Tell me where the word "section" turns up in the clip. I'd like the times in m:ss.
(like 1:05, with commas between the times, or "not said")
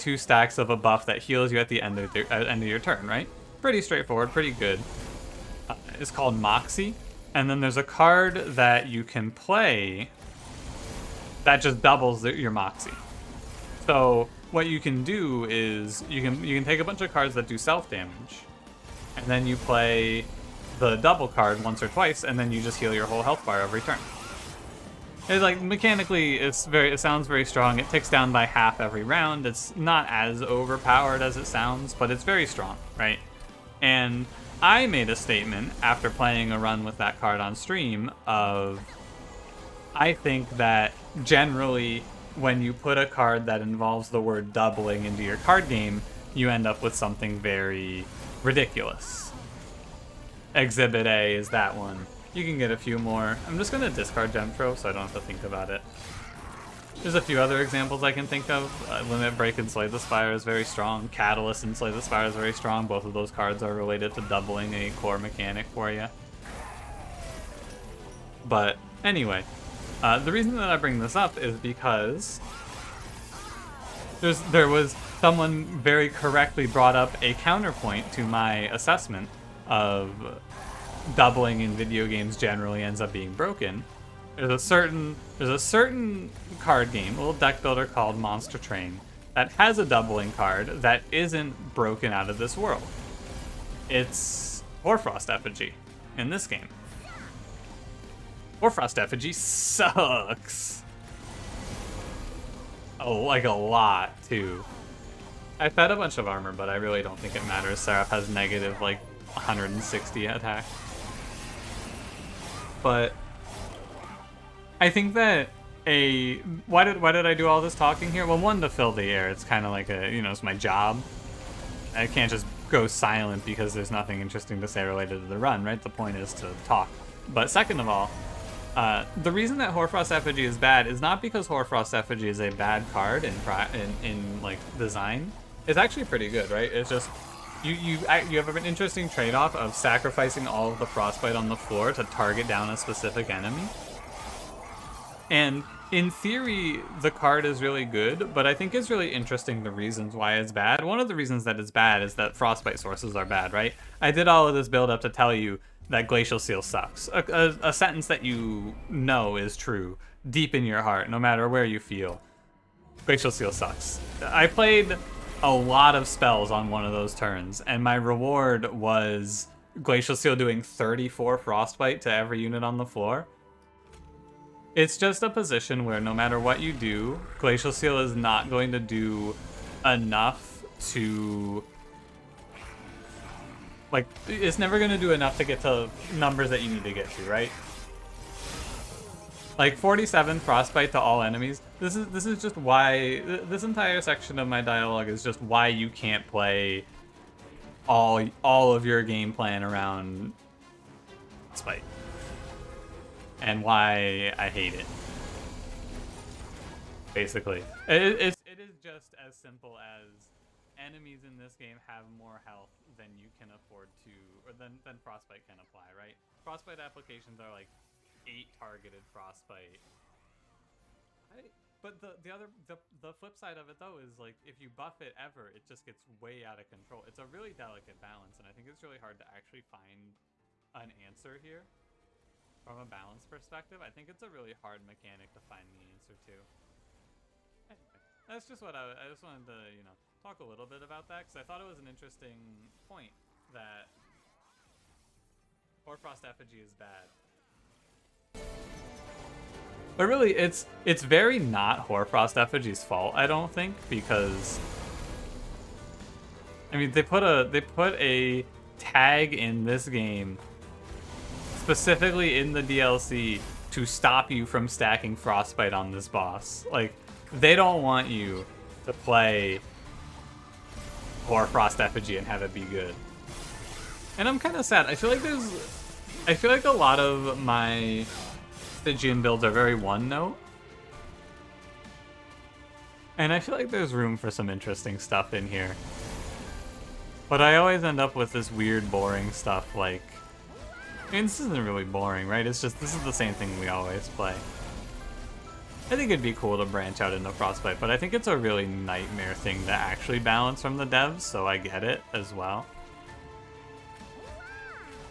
3:14.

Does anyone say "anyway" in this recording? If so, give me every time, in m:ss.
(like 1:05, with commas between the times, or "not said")
1:09, 3:57.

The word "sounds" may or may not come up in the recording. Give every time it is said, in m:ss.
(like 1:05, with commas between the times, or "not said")
0:26, 0:31.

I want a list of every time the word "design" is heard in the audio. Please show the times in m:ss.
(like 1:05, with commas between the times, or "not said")
2:14.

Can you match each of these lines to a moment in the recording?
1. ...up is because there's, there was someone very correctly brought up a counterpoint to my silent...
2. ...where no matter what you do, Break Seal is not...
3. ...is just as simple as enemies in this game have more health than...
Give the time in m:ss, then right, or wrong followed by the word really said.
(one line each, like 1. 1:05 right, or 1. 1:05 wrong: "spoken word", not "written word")
1. 1:11 wrong: "assessment", not "silent"
2. 2:55 wrong: "Glacial", not "Break"
3. 3:28 right.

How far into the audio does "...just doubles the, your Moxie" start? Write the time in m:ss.
0:11.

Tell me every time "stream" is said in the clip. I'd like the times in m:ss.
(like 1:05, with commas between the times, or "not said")
0:37.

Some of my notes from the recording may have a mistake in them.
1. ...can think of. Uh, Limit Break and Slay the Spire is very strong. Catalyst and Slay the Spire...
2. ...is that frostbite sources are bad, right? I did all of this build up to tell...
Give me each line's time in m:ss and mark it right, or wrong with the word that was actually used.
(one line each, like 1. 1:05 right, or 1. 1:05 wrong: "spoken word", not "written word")
1. 0:58 right
2. 2:32 right.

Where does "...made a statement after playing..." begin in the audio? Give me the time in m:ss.
0:34.